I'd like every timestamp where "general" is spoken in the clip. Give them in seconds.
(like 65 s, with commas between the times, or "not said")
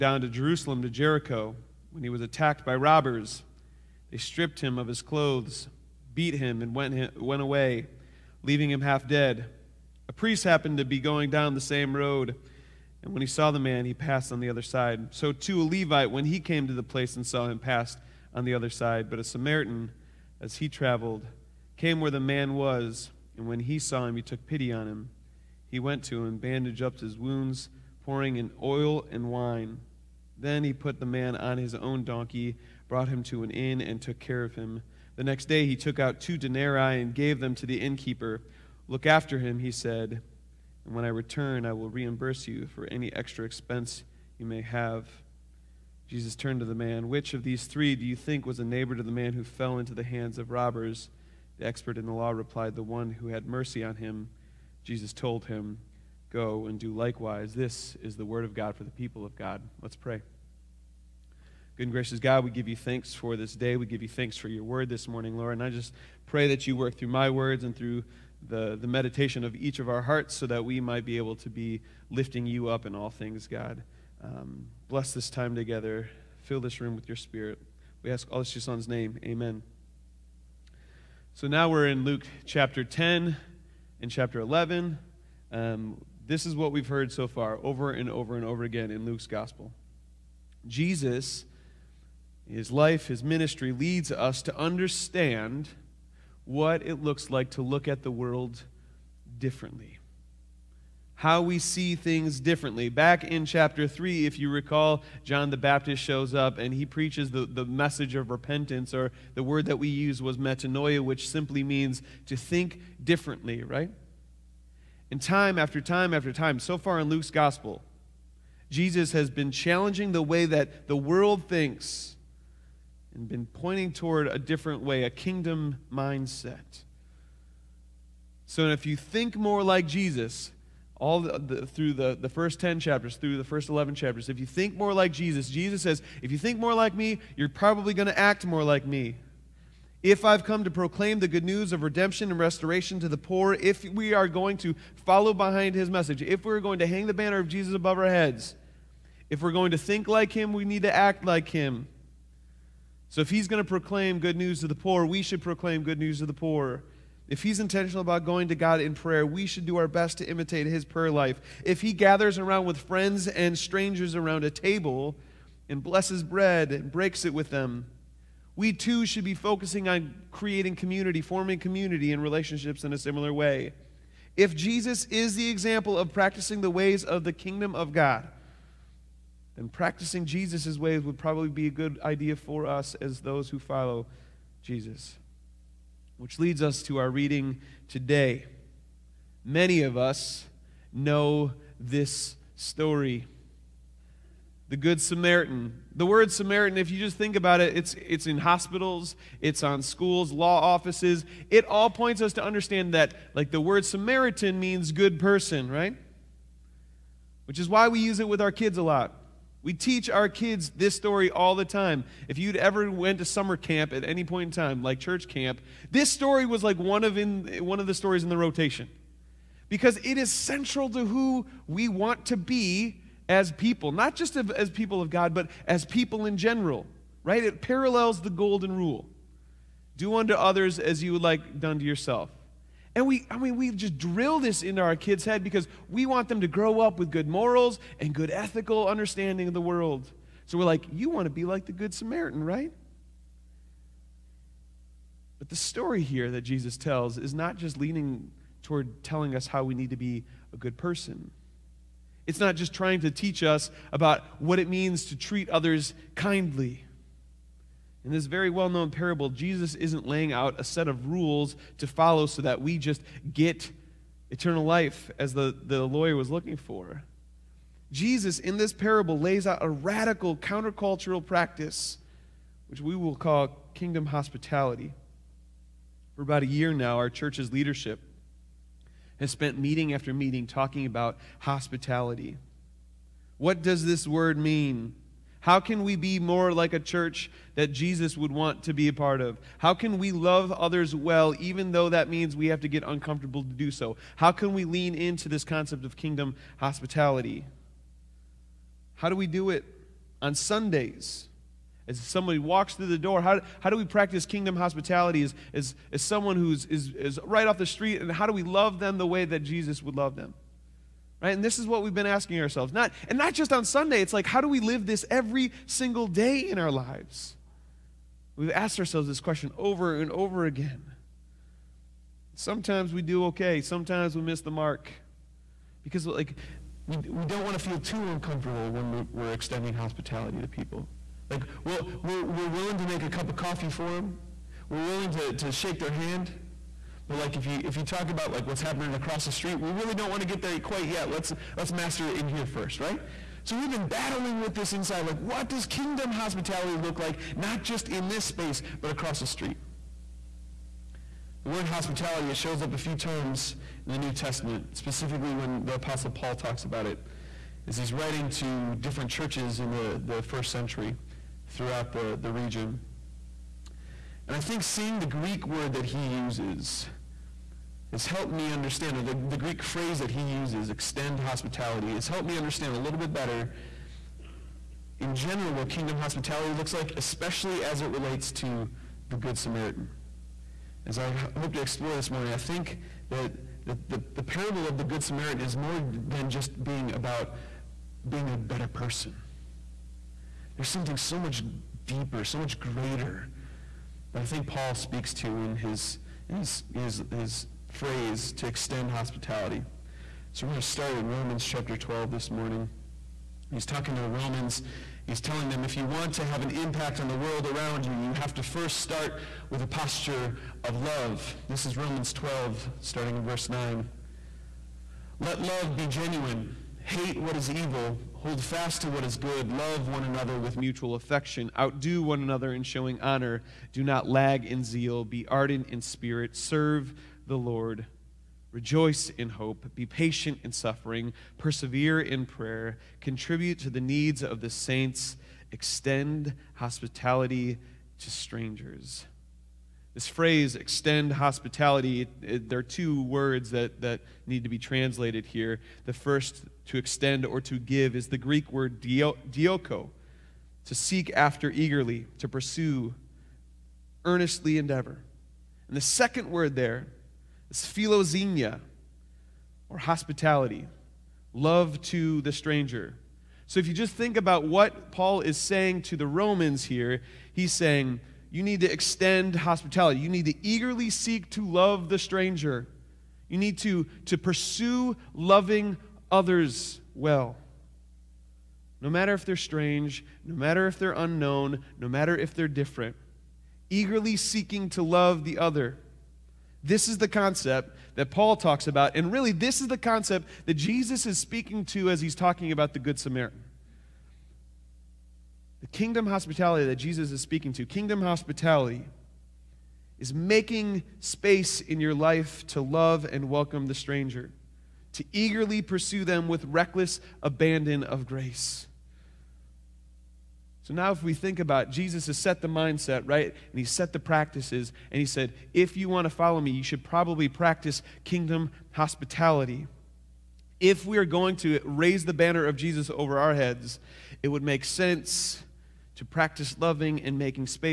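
226 s, 375 s.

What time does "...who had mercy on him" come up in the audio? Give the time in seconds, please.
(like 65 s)
53 s.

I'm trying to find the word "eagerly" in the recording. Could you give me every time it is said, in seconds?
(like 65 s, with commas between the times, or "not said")
451 s, 470 s, 483 s, 505 s.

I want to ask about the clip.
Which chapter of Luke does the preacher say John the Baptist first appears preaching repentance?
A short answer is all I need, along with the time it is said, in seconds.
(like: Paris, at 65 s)
Chapter 3, at 103 s.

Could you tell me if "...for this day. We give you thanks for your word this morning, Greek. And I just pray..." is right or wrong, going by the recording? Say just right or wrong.
wrong.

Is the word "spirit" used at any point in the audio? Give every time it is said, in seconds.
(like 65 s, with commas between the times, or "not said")
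77 s, 425 s.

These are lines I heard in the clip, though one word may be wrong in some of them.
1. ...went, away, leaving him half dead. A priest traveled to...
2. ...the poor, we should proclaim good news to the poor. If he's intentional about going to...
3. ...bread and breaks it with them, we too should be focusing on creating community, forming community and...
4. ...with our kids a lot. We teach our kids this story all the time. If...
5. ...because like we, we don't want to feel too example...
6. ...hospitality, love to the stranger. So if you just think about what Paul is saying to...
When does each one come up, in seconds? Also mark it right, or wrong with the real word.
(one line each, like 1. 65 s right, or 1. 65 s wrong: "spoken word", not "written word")
1. 6 s wrong: "happened", not "traveled"
2. 154 s right
3. 166 s right
4. 208 s right
5. 325 s wrong: "uncomfortable", not "example"
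6. 459 s right.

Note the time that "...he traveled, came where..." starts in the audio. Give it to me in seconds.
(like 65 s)
20 s.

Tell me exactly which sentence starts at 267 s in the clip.
Jesus, in this parable, lays out a radical countercultural practice, which we will call kingdom hospitality.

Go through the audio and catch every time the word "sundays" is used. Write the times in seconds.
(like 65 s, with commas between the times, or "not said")
300 s, 313 s.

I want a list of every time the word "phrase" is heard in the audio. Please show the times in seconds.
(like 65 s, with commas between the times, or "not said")
369 s, 397 s, 440 s.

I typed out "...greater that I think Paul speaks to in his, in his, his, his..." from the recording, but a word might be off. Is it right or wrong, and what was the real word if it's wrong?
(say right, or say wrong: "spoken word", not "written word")
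right.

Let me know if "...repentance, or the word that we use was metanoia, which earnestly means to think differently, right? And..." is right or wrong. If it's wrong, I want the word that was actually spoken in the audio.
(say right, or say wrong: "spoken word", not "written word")
wrong: "simply", not "earnestly".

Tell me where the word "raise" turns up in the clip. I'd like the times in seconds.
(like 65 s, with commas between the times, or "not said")
521 s.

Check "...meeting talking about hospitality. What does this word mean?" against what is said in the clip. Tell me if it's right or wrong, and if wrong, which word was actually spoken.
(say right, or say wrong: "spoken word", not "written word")
right.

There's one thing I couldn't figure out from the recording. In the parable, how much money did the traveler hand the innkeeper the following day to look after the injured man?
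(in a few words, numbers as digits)
2 denarii.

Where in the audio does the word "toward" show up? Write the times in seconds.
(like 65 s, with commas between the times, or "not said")
123 s, 248 s.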